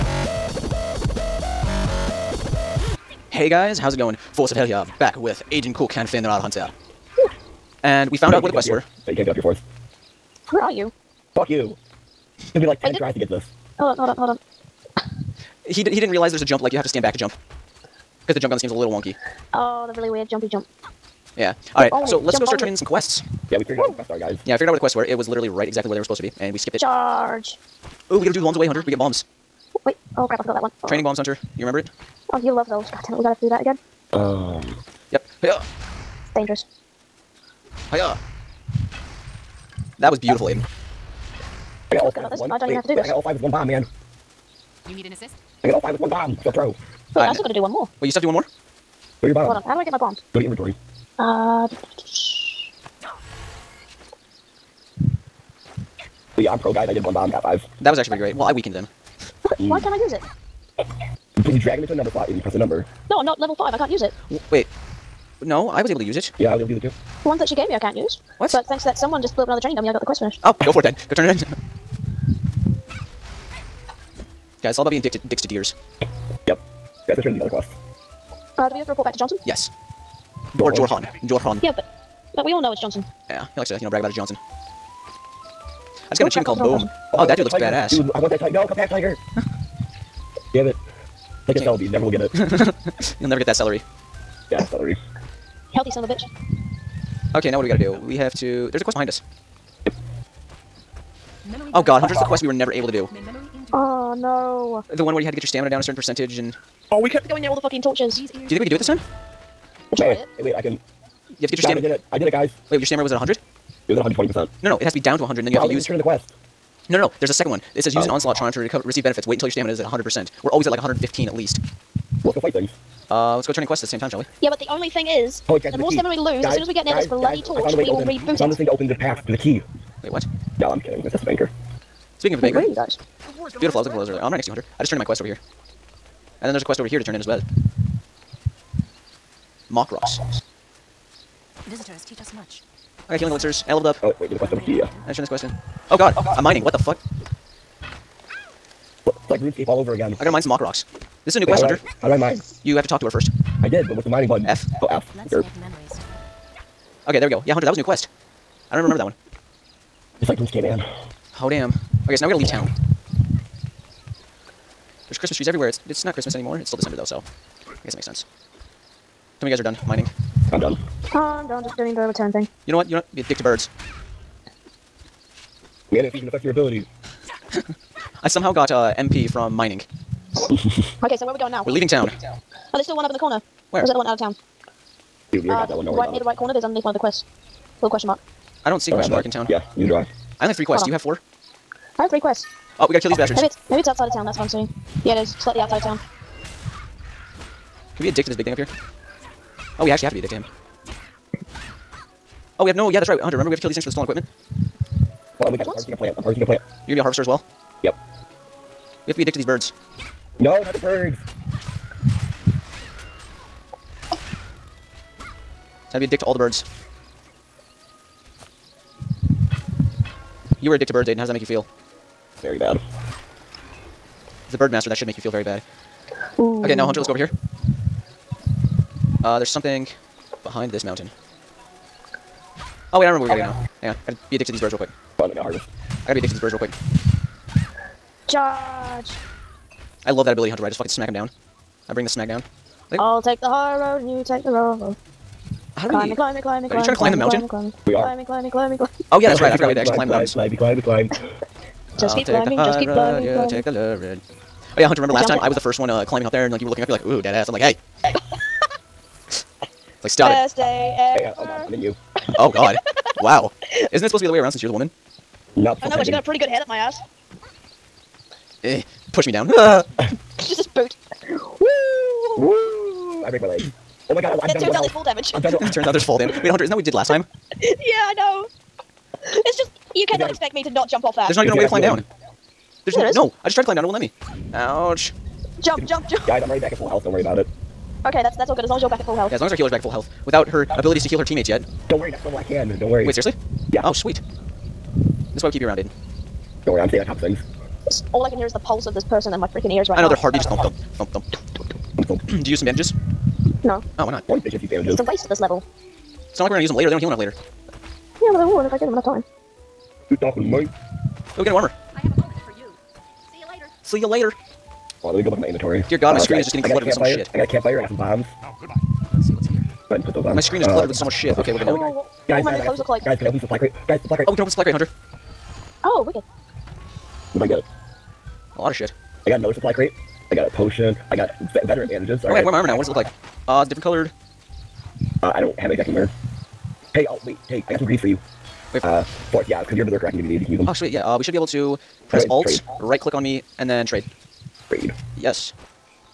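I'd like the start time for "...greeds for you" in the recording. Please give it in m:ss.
5:37.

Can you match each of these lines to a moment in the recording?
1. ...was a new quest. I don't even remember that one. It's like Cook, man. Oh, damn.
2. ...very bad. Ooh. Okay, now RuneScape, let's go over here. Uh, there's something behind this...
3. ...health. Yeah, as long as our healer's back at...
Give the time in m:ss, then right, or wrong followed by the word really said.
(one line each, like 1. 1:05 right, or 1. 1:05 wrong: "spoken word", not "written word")
1. 2:37 wrong: "RuneScape", not "Cook"
2. 3:45 wrong: "Hunter", not "RuneScape"
3. 4:49 right.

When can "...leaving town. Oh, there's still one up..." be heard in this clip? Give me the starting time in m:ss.
3:01.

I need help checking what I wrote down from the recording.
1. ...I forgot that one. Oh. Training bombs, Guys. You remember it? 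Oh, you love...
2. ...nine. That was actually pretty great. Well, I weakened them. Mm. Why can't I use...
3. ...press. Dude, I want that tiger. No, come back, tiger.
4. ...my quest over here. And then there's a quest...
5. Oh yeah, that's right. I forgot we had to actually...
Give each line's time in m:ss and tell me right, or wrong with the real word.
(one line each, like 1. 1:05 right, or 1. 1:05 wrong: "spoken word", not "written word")
1. 0:30 wrong: "Hunter", not "Guys"
2. 0:57 wrong: "five", not "nine"
3. 1:27 wrong: "badass", not "press"
4. 2:14 right
5. 4:09 right.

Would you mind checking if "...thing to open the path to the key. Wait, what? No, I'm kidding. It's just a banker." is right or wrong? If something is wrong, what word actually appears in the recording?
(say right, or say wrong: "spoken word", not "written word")
right.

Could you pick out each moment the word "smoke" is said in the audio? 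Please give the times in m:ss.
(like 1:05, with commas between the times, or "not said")
not said.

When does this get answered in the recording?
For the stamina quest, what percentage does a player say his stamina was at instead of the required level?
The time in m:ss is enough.
1:53.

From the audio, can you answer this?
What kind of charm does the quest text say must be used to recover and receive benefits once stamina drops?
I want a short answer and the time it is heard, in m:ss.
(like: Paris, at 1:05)
onslaught charm, at 1:58.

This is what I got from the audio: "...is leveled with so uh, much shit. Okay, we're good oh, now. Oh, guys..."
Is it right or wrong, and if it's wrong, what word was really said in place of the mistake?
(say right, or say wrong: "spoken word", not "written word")
wrong: "cluttered", not "leveled".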